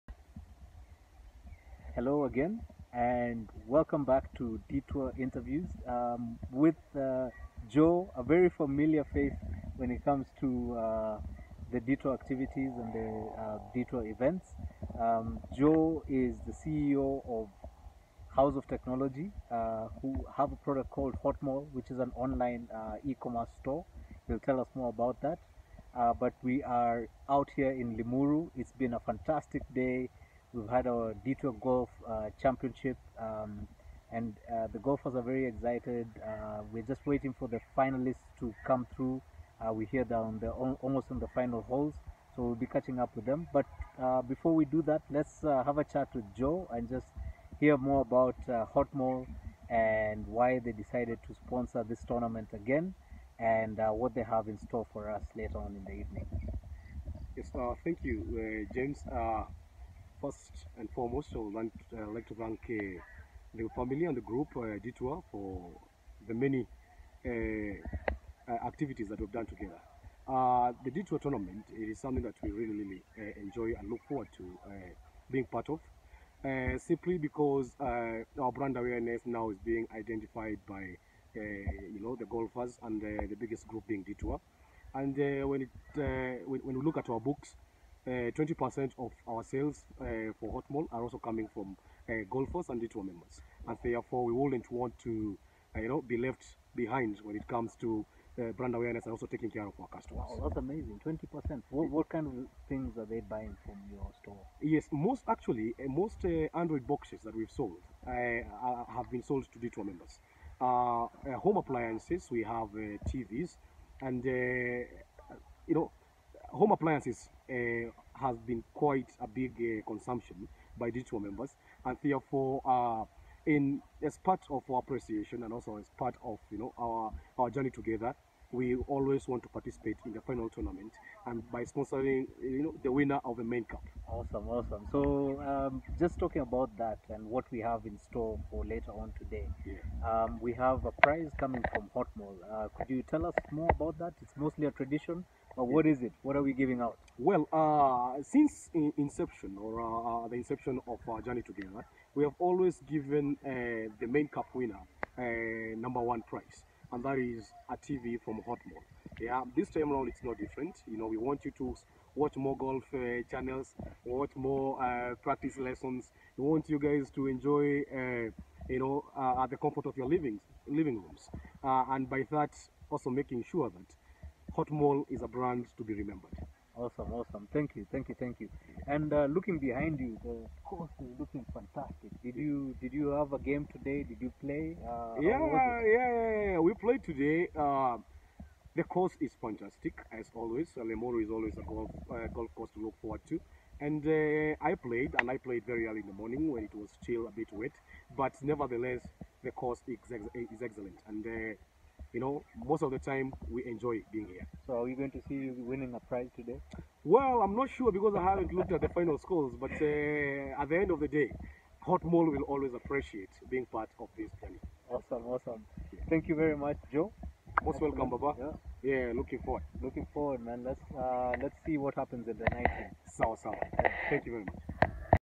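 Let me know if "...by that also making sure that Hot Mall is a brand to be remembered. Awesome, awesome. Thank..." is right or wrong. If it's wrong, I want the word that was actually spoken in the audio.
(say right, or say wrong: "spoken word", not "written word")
right.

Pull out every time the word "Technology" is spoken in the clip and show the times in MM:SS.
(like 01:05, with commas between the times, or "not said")
00:18.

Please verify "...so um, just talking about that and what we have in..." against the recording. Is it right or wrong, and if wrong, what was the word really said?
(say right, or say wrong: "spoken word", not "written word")
right.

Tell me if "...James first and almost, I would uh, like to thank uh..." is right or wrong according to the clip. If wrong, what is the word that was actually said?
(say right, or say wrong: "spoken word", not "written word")
wrong: "foremost", not "almost".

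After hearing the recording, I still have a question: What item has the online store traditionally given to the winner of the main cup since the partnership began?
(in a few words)
A TV.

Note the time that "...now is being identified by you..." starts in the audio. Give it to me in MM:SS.
01:19.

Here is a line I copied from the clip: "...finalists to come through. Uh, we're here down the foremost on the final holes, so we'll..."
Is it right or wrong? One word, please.
wrong.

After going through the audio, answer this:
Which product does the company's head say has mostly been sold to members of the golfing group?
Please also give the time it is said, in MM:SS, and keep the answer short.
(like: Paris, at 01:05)
Android boxes, at 01:46.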